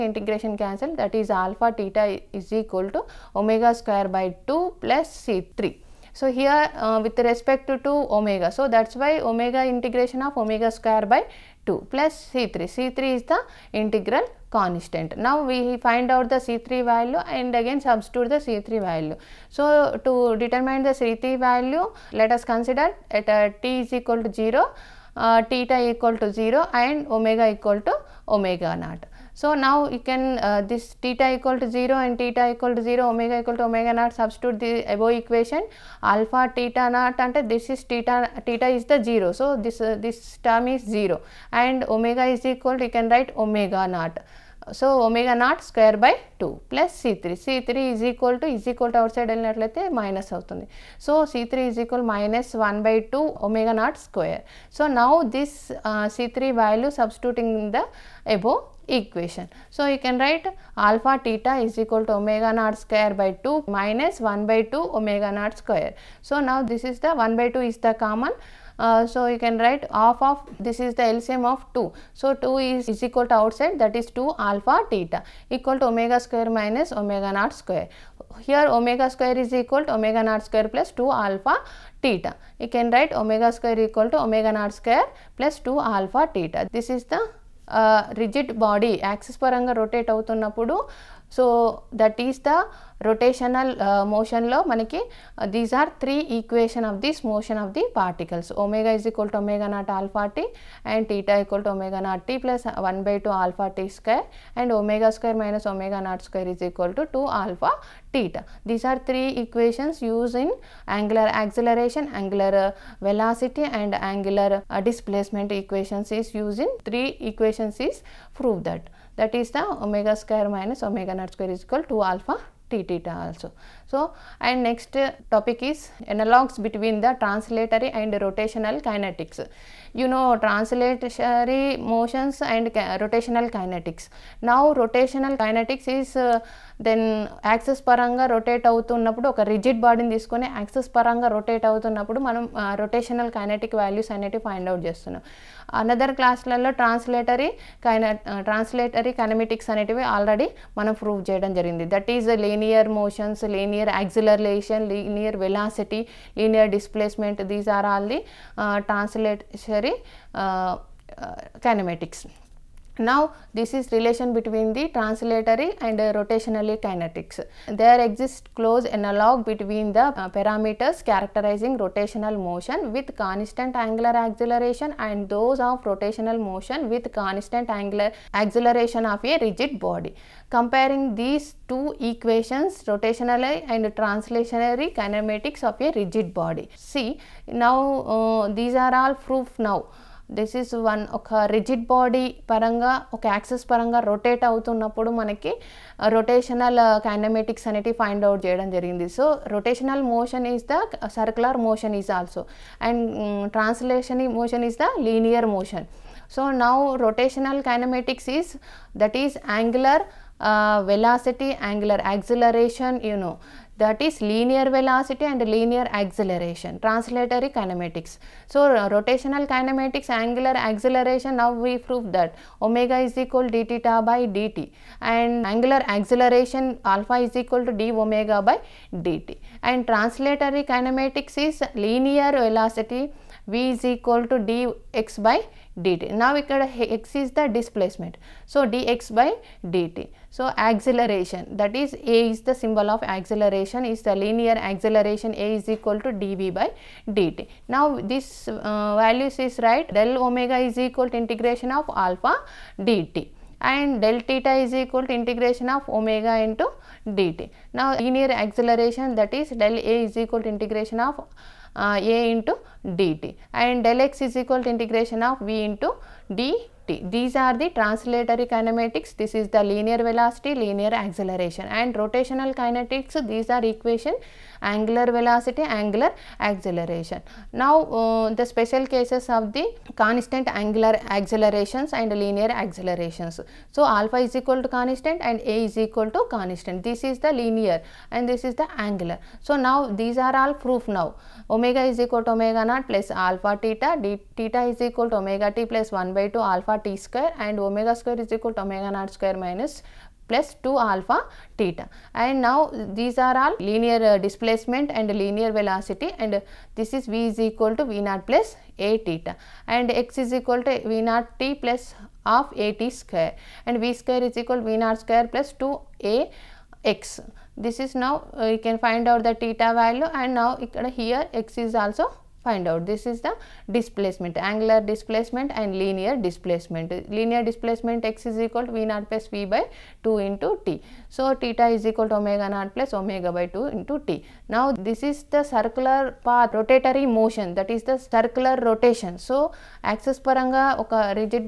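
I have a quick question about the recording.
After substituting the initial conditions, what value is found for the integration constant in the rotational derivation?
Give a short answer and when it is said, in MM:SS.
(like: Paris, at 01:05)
minus 1 by 2 omega naught square, at 00:52.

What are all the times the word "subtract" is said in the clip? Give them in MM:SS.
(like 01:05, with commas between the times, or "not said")
not said.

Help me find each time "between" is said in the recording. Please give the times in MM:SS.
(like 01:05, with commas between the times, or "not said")
02:06, 02:44, 02:49.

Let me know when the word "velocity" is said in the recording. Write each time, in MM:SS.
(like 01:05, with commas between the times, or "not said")
01:53, 03:34, 03:52, 04:29, 04:35, 05:05.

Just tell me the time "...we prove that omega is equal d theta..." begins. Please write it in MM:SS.
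03:41.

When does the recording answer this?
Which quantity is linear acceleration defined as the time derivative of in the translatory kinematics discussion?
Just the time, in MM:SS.
04:06.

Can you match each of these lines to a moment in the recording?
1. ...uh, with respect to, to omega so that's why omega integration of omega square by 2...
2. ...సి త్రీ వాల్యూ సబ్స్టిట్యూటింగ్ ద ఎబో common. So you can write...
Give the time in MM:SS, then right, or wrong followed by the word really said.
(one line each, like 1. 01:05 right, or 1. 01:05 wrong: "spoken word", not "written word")
1. 00:06 right
2. 00:56 wrong: "equation", not "common".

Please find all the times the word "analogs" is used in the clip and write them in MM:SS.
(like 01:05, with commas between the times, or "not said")
02:06, 02:48.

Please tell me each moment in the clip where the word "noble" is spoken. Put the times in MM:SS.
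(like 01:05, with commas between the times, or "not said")
not said.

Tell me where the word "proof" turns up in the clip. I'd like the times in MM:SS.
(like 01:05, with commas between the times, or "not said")
03:09, 04:50.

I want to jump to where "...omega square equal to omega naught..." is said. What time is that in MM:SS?
01:23.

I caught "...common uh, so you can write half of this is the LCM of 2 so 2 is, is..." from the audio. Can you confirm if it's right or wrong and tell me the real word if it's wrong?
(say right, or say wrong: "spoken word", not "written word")
right.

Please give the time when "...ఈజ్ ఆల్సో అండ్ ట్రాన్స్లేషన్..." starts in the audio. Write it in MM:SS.
03:22.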